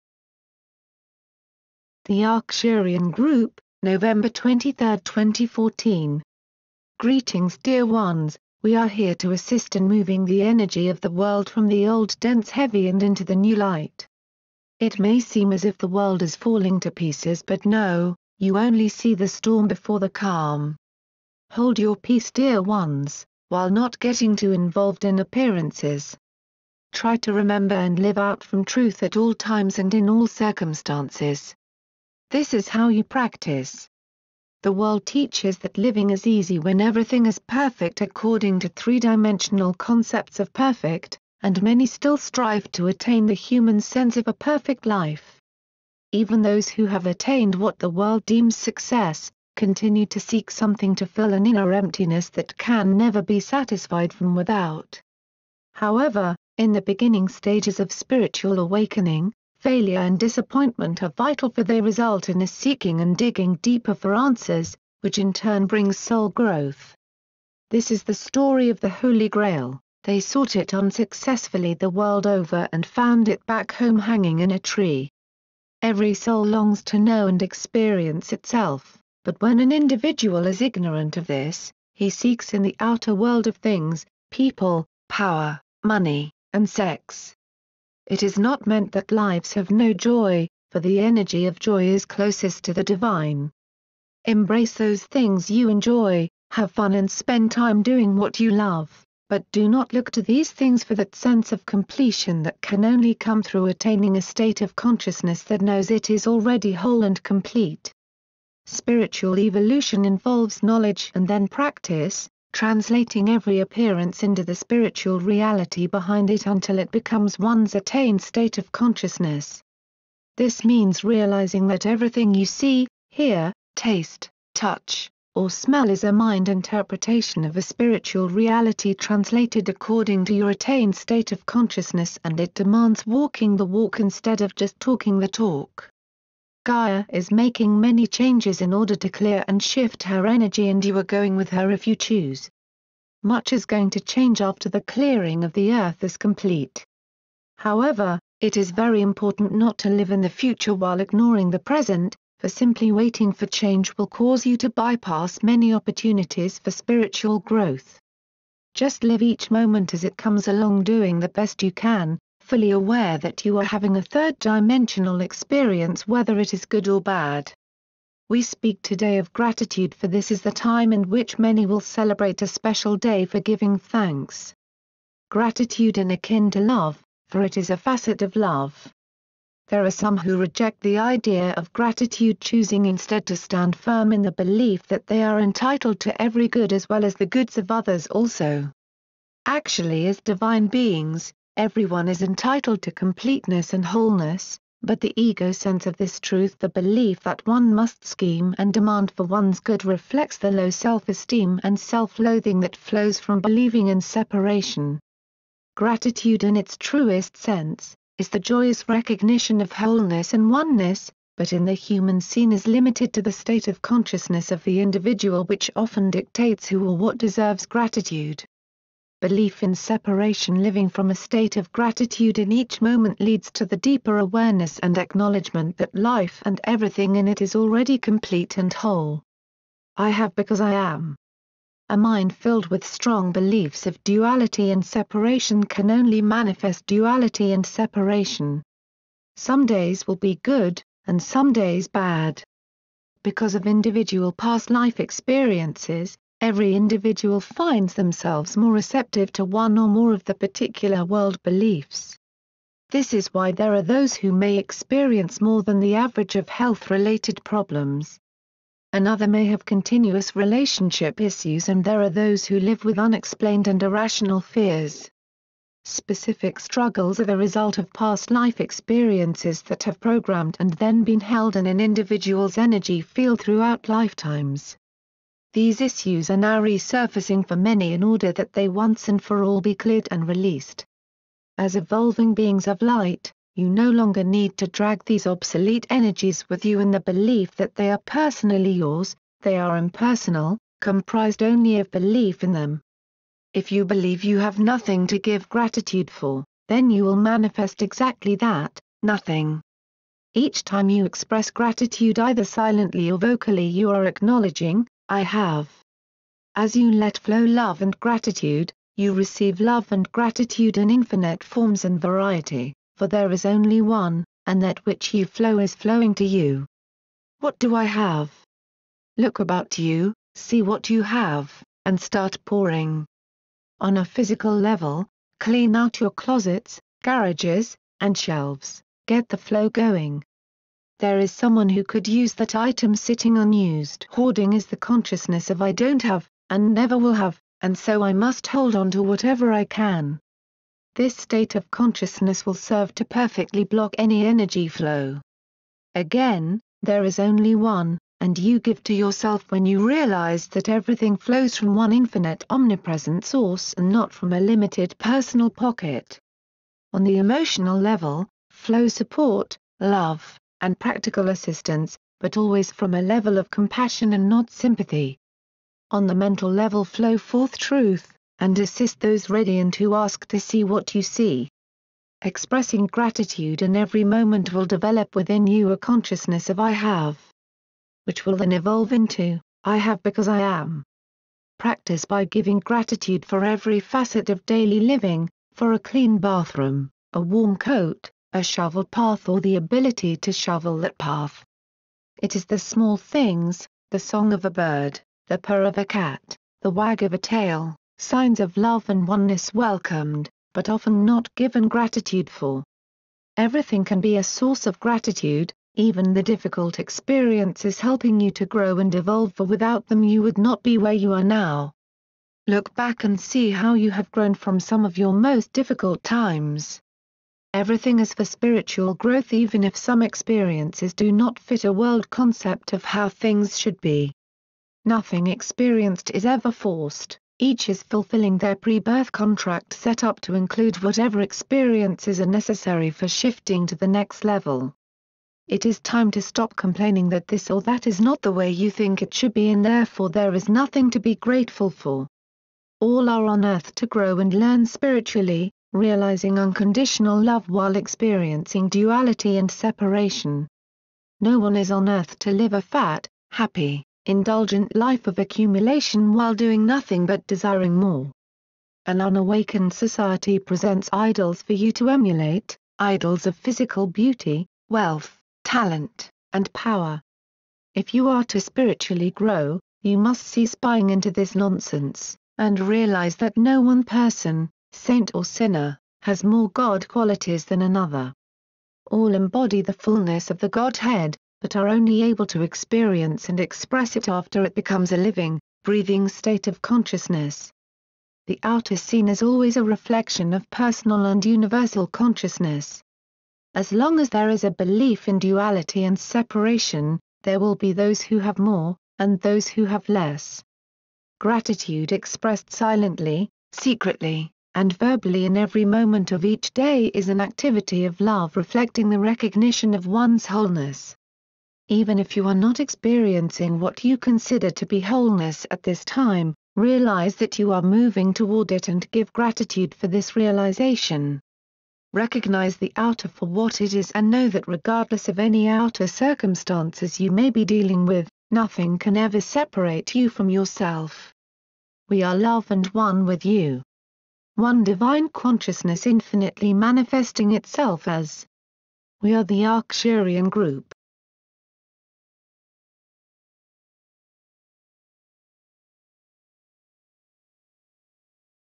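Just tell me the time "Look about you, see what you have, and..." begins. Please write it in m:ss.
5:19.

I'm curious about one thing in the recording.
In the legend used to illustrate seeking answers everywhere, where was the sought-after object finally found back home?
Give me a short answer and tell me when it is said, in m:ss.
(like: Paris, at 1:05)
hanging in a tree, at 1:13.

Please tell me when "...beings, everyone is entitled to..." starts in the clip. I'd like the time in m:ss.
3:10.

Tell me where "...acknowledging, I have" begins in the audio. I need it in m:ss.
5:04.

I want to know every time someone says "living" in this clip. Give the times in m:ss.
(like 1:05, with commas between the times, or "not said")
0:35, 3:40, 6:24, 8:04.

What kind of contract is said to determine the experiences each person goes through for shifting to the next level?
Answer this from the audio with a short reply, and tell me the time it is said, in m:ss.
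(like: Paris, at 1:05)
pre-birth contract, at 7:08.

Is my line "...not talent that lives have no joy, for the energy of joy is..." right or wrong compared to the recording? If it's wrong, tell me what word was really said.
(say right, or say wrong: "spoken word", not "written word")
wrong: "meant", not "talent".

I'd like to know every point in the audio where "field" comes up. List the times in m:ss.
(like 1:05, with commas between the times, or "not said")
4:32.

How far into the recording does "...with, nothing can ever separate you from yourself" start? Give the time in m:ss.
8:47.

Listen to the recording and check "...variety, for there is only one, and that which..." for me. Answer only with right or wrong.
right.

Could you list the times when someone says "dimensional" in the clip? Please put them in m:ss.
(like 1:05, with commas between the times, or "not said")
0:38, 2:44.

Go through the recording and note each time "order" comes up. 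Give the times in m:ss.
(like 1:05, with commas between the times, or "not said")
2:18, 4:38.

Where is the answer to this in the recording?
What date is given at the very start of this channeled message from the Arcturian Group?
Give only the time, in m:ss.
0:03.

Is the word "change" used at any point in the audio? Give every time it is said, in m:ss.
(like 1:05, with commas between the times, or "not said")
2:18, 2:23, 2:33.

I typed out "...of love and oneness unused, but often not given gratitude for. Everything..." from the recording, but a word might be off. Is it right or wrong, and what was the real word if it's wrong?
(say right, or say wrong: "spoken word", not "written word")
wrong: "welcomed", not "unused".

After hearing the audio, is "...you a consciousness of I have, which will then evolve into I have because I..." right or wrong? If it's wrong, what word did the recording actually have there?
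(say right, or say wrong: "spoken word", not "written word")
right.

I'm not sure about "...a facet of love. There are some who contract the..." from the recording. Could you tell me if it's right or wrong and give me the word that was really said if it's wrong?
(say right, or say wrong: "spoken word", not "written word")
wrong: "reject", not "contract".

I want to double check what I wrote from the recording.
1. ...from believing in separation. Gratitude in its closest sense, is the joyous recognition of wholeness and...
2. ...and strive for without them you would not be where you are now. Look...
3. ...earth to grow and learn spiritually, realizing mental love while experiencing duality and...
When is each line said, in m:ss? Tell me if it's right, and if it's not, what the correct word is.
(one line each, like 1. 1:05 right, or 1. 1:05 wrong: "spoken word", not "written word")
1. 3:23 wrong: "truest", not "closest"
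2. 6:48 wrong: "evolve", not "strive"
3. 7:23 wrong: "unconditional", not "mental".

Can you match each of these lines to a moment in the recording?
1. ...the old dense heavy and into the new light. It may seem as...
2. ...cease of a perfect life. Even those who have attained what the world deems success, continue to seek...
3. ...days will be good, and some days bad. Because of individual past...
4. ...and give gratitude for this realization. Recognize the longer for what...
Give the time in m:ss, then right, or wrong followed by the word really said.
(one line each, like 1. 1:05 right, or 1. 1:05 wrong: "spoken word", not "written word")
1. 0:11 right
2. 0:43 wrong: "sense", not "cease"
3. 3:59 right
4. 8:38 wrong: "outer", not "longer".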